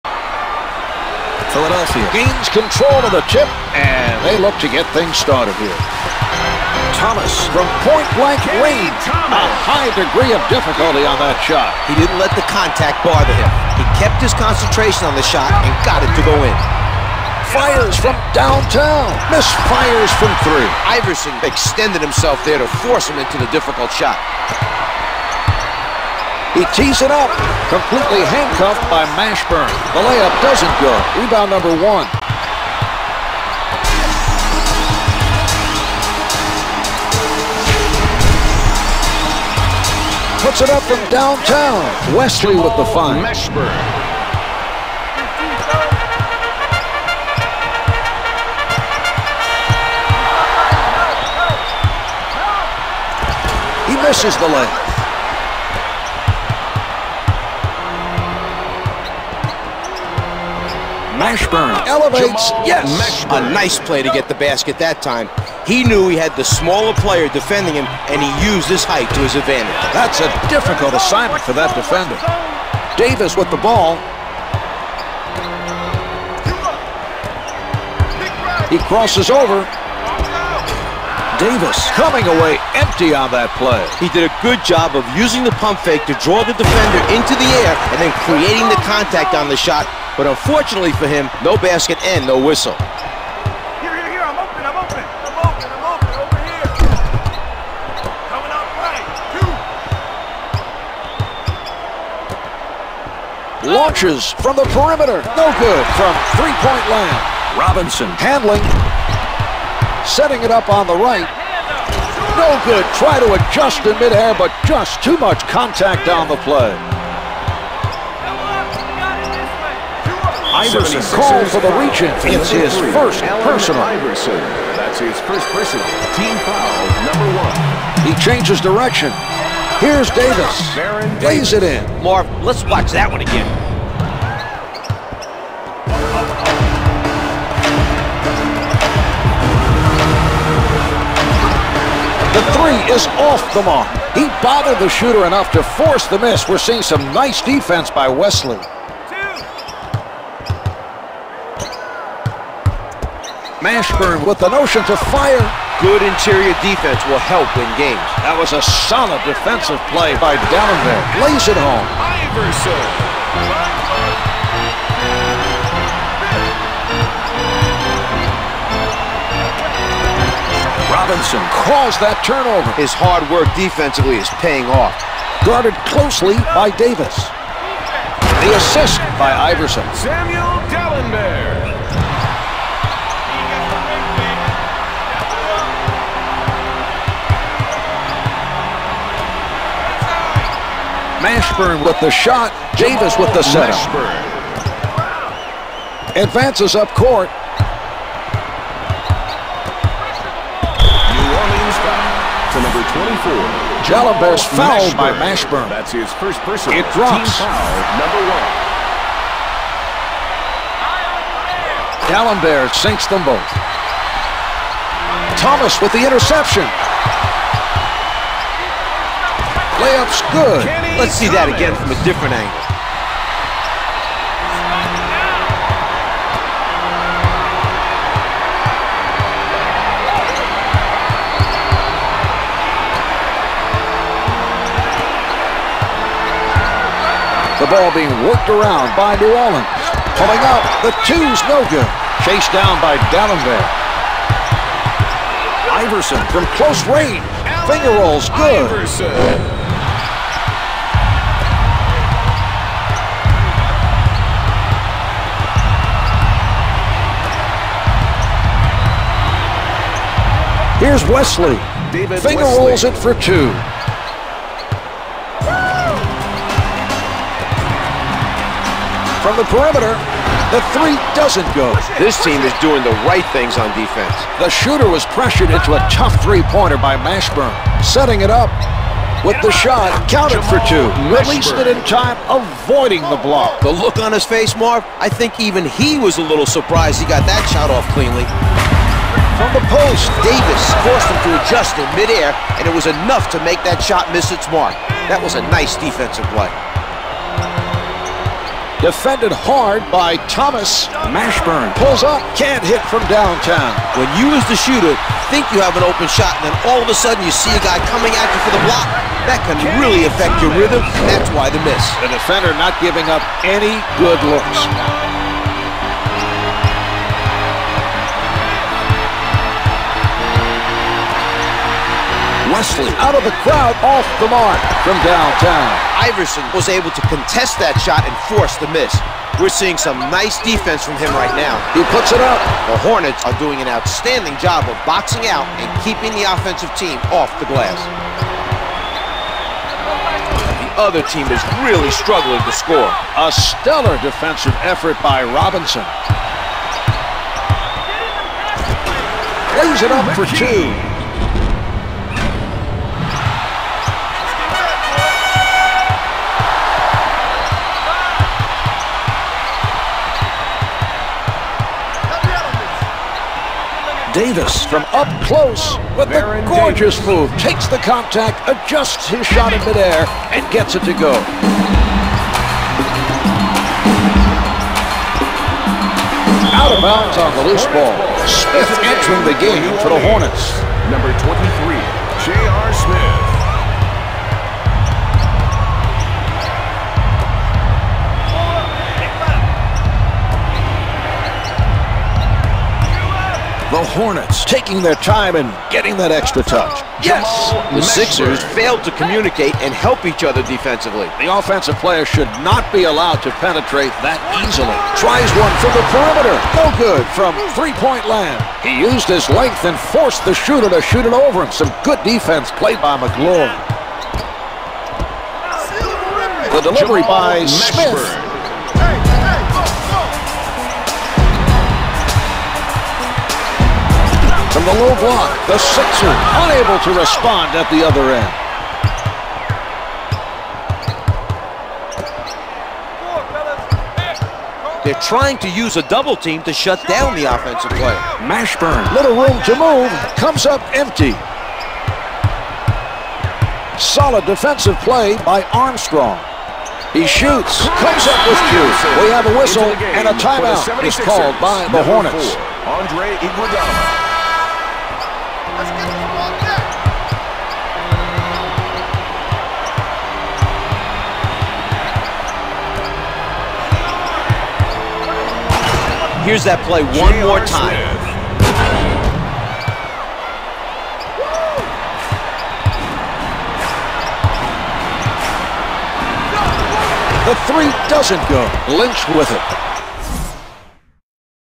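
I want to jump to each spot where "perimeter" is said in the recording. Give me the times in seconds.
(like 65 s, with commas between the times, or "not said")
104 s, 269 s, 405 s.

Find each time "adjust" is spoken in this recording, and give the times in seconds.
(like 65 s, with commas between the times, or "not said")
113 s, 291 s, 368 s.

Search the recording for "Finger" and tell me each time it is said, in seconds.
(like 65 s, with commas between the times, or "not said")
247 s, 262 s.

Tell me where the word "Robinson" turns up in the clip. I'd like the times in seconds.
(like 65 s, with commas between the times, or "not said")
107 s, 170 s, 345 s.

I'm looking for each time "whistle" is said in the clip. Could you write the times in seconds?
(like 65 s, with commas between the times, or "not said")
92 s, 449 s.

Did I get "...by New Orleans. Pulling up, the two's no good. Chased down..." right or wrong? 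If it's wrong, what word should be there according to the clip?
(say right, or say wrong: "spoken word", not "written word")
right.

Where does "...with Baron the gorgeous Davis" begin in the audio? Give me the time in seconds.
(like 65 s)
365 s.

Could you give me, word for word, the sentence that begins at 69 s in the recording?
That's a difficult assignment for that defender.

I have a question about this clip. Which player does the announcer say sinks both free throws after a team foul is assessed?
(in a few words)
Allen.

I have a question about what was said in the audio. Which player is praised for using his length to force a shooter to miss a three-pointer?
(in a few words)
Magloire.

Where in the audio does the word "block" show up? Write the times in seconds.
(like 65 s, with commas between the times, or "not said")
283 s, 308 s, 424 s.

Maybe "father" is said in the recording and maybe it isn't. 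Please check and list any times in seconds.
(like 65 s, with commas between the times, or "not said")
not said.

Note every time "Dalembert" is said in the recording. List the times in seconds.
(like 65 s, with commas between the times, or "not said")
160 s, 180 s, 243 s.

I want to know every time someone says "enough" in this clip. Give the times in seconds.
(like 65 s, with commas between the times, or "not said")
145 s, 292 s.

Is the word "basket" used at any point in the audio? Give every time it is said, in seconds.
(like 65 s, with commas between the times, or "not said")
64 s, 91 s.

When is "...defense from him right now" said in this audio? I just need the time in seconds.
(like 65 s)
330 s.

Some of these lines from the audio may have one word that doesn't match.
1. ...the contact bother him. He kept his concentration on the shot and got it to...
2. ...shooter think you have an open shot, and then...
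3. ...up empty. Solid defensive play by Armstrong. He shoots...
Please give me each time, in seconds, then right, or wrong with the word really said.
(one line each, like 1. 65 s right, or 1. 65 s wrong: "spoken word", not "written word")
1. 12 s right
2. 304 s right
3. 440 s right.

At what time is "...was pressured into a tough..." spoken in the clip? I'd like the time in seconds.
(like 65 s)
274 s.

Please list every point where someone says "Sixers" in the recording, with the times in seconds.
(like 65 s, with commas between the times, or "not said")
397 s, 425 s.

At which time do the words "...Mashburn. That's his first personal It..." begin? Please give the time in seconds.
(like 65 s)
205 s.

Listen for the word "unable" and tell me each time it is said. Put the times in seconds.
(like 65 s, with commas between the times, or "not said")
426 s.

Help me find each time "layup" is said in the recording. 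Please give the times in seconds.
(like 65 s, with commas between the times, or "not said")
30 s, 54 s, 219 s.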